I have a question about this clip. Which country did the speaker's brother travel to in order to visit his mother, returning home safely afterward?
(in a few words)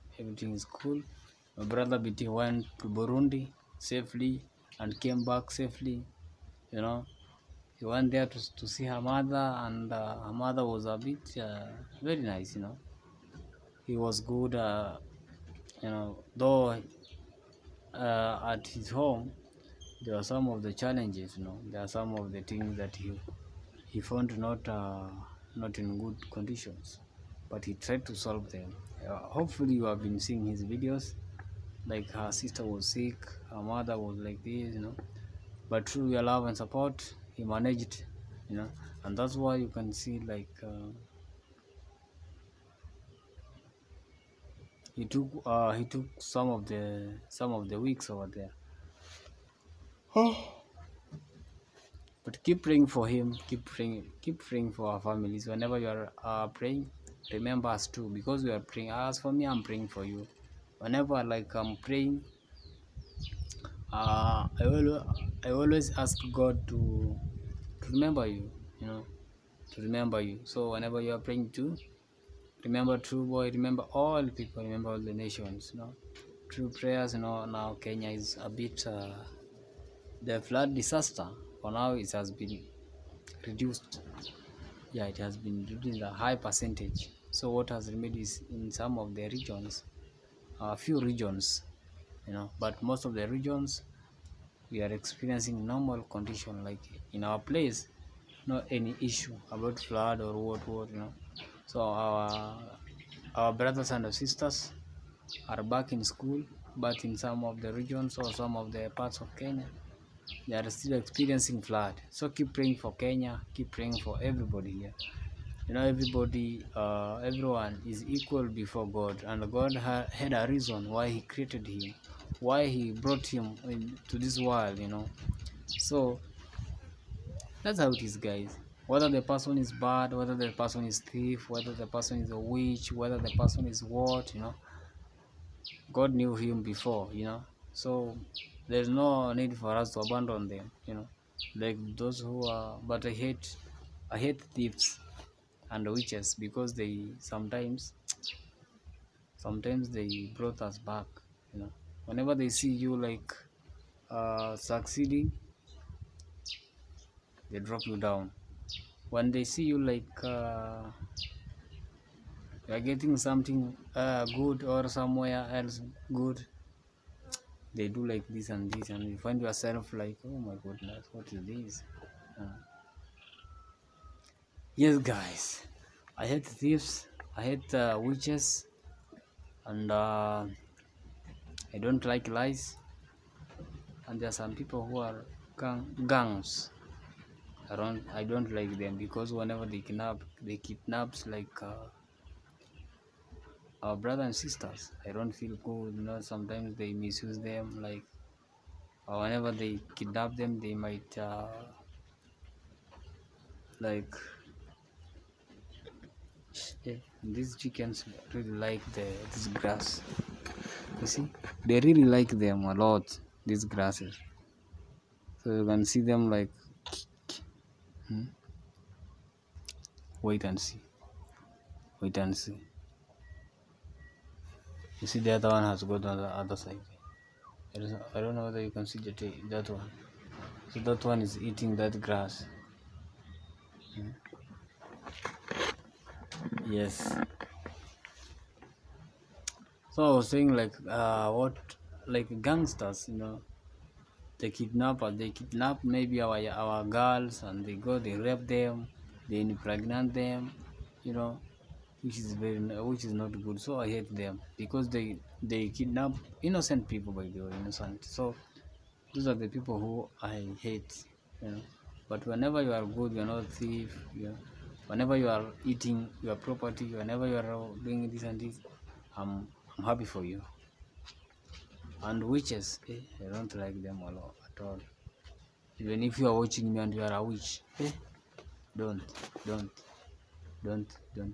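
Burundi.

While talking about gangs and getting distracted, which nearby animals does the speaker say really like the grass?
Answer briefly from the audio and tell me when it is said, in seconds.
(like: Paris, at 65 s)
chickens, at 207 s.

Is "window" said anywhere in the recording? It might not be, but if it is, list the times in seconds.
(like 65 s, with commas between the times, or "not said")
not said.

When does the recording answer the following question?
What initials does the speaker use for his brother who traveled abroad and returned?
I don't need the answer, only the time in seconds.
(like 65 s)
1 s.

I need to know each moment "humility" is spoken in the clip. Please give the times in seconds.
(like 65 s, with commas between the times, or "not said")
not said.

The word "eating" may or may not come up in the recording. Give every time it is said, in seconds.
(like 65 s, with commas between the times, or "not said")
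231 s, 265 s.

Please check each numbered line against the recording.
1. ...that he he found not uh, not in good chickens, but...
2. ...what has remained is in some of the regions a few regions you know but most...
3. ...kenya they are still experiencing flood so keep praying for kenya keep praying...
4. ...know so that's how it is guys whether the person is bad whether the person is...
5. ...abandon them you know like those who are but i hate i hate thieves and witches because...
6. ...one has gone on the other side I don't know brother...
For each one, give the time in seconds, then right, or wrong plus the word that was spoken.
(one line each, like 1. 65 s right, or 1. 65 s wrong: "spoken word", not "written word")
1. 22 s wrong: "conditions", not "chickens"
2. 87 s right
3. 109 s right
4. 124 s right
5. 139 s right
6. 225 s wrong: "whether", not "brother".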